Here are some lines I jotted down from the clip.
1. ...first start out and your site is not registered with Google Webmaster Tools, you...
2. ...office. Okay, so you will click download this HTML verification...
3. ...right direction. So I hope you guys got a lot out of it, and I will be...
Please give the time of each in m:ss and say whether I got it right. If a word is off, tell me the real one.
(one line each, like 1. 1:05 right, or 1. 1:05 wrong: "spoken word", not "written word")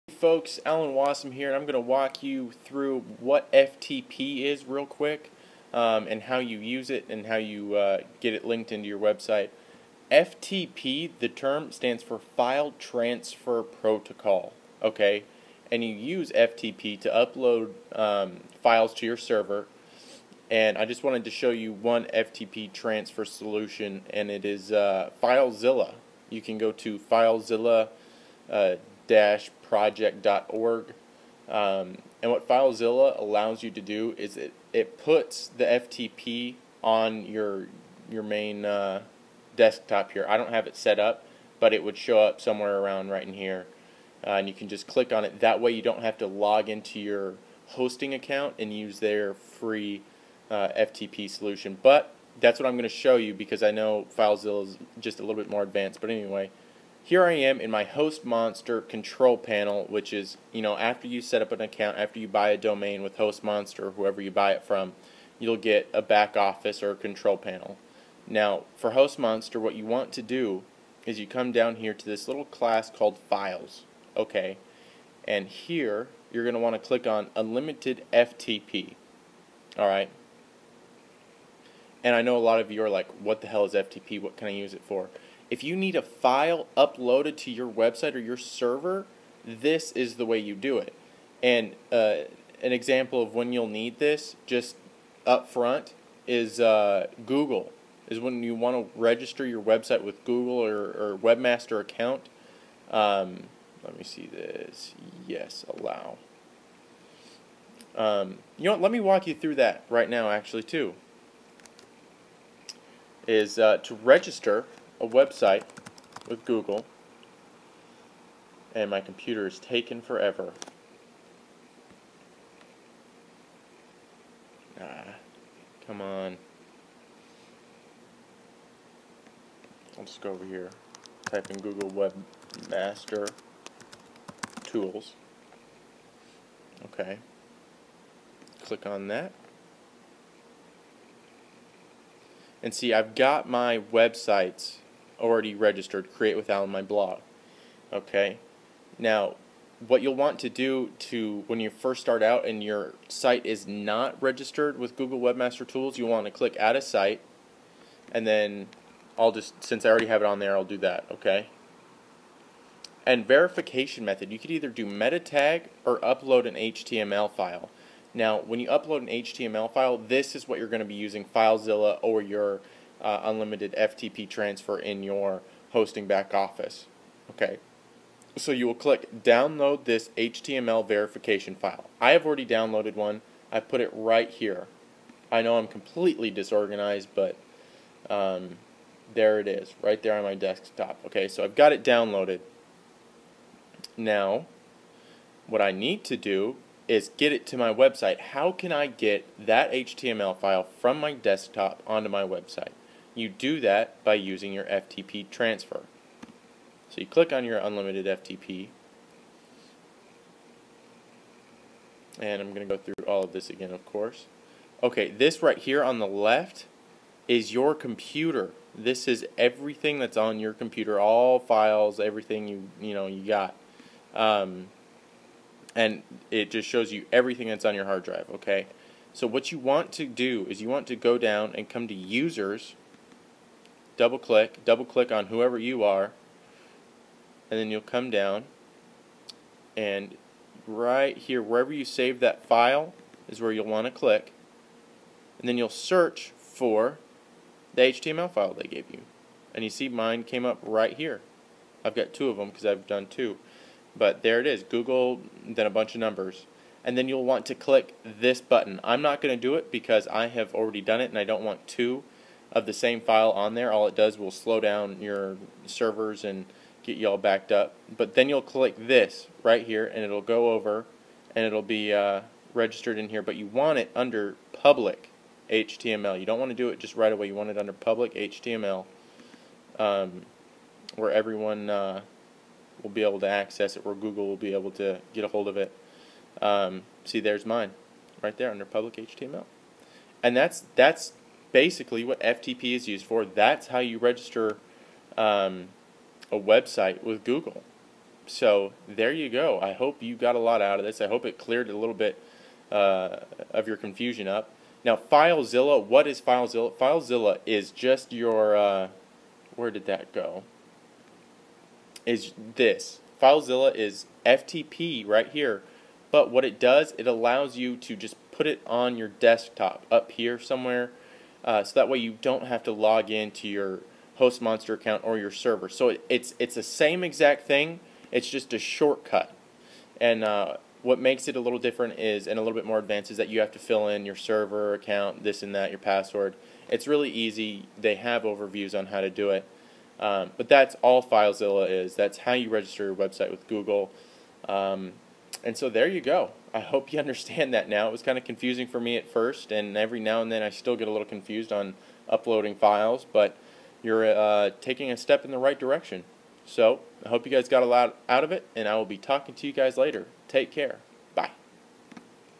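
1. 2:31 right
2. 2:56 right
3. 5:55 right.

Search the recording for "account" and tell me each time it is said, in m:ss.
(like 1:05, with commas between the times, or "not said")
0:48, 1:01, 1:41, 5:24, 5:34.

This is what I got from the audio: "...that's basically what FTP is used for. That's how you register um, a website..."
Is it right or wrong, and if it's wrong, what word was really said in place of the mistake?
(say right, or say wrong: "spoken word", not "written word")
right.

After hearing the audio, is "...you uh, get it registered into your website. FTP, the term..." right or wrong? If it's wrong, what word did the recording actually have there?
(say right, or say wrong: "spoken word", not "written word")
wrong: "linked", not "registered".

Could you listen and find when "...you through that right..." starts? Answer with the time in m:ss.
1:49.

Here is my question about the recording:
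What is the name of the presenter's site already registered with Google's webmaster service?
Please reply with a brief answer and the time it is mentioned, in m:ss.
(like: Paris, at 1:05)
Create with Alan, at 2:26.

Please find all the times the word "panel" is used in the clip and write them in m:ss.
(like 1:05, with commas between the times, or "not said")
0:59, 1:07.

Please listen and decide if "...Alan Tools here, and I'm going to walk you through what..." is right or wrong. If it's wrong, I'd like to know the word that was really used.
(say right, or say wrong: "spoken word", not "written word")
wrong: "Wasem", not "Tools".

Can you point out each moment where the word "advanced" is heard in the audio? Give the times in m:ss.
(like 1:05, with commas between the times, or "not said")
0:55, 5:32.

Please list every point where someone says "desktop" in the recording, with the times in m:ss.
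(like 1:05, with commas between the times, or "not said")
0:39, 3:10, 3:21, 5:19.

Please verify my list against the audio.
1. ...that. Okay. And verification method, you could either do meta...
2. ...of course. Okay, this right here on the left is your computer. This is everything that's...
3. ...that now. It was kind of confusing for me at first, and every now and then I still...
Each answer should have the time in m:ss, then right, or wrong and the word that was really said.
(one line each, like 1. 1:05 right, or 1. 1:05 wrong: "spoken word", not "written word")
1. 2:40 right
2. 3:33 right
3. 5:47 right.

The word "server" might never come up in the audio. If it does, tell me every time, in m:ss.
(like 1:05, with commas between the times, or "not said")
0:19, 1:28, 4:25, 5:25, 5:34.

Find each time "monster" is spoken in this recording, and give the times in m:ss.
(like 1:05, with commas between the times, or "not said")
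0:58, 1:03, 1:09, 5:24.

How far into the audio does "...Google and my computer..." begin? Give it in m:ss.
1:56.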